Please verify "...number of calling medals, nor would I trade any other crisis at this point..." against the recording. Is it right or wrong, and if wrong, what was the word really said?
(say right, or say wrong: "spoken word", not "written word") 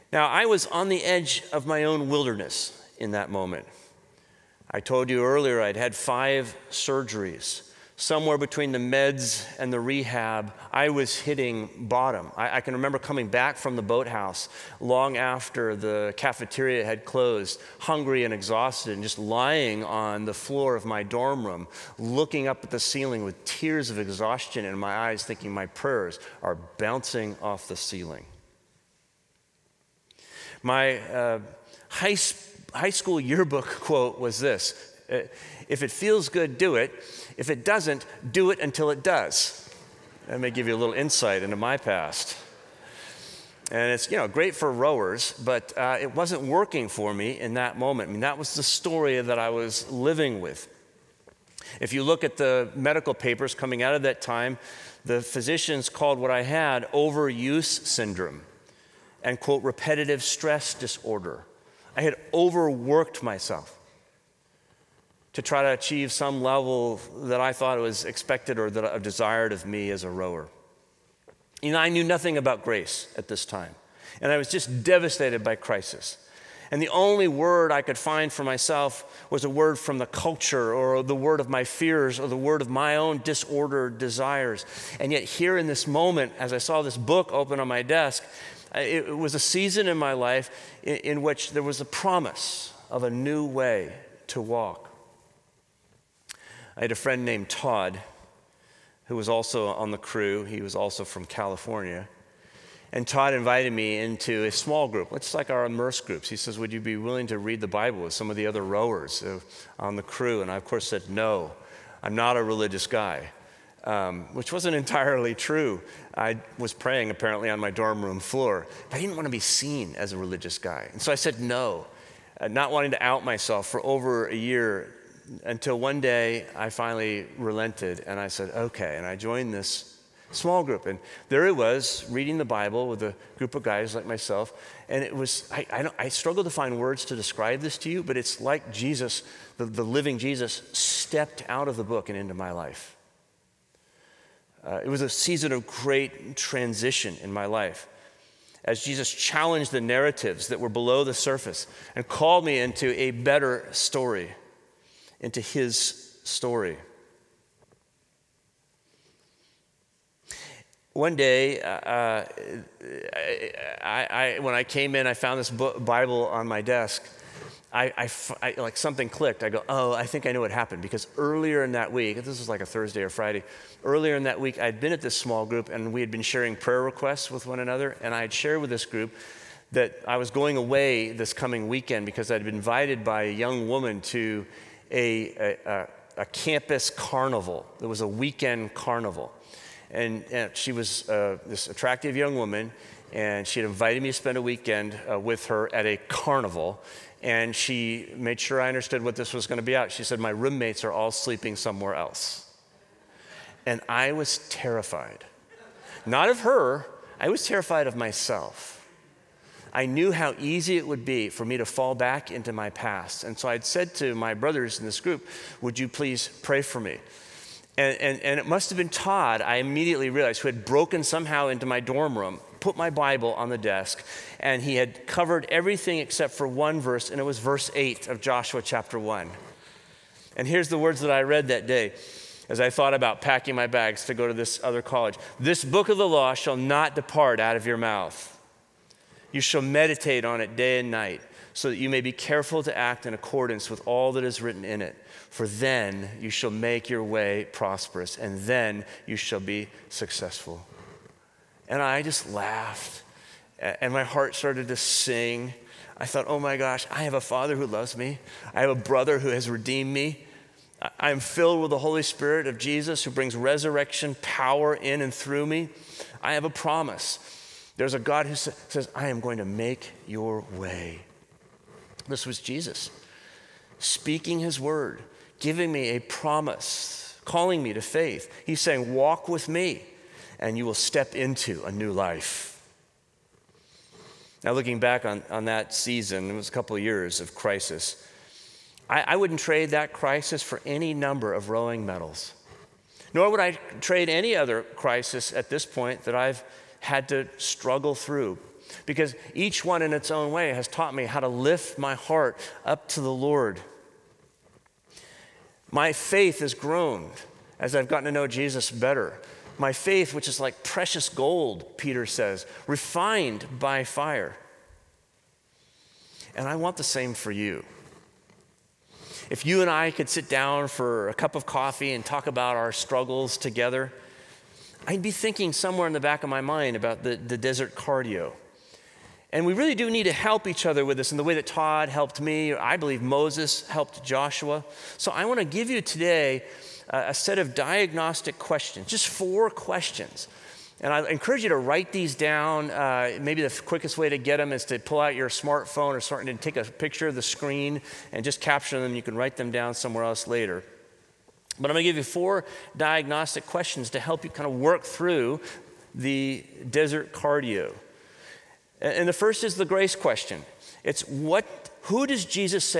wrong: "rowing", not "calling".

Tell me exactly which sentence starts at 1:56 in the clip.
I was praying apparently on my dorm room floor, but I didn't want to be seen as a religious guy.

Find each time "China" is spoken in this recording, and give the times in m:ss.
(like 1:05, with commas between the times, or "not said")
not said.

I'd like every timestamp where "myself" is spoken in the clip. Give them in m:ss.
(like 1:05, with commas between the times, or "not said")
1:03, 1:18, 2:03, 2:14, 3:27.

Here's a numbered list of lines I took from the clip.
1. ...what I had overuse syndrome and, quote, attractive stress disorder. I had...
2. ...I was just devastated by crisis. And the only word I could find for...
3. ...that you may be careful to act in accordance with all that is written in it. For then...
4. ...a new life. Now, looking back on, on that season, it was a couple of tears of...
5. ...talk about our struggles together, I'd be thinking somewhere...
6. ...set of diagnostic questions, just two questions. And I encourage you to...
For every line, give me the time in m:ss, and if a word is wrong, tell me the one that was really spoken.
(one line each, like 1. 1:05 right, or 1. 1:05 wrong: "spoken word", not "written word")
1. 0:56 wrong: "repetitive", not "attractive"
2. 1:14 right
3. 4:01 right
4. 4:41 wrong: "years", not "tears"
5. 5:22 right
6. 5:37 wrong: "four", not "two".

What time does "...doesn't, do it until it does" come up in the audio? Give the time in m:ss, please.
0:37.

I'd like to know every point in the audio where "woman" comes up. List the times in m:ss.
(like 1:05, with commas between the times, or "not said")
3:03, 3:12.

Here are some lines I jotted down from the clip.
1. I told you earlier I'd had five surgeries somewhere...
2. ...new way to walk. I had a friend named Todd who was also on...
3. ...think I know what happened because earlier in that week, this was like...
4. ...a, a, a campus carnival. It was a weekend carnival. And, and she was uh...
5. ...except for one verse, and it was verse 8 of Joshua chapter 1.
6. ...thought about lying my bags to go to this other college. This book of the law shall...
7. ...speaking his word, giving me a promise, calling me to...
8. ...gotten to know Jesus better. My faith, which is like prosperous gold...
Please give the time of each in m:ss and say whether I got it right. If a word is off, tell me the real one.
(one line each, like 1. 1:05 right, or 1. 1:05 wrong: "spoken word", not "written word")
1. 0:04 right
2. 1:33 right
3. 2:50 right
4. 3:04 right
5. 3:45 right
6. 3:52 wrong: "packing", not "lying"
7. 4:33 right
8. 5:07 wrong: "precious", not "prosperous".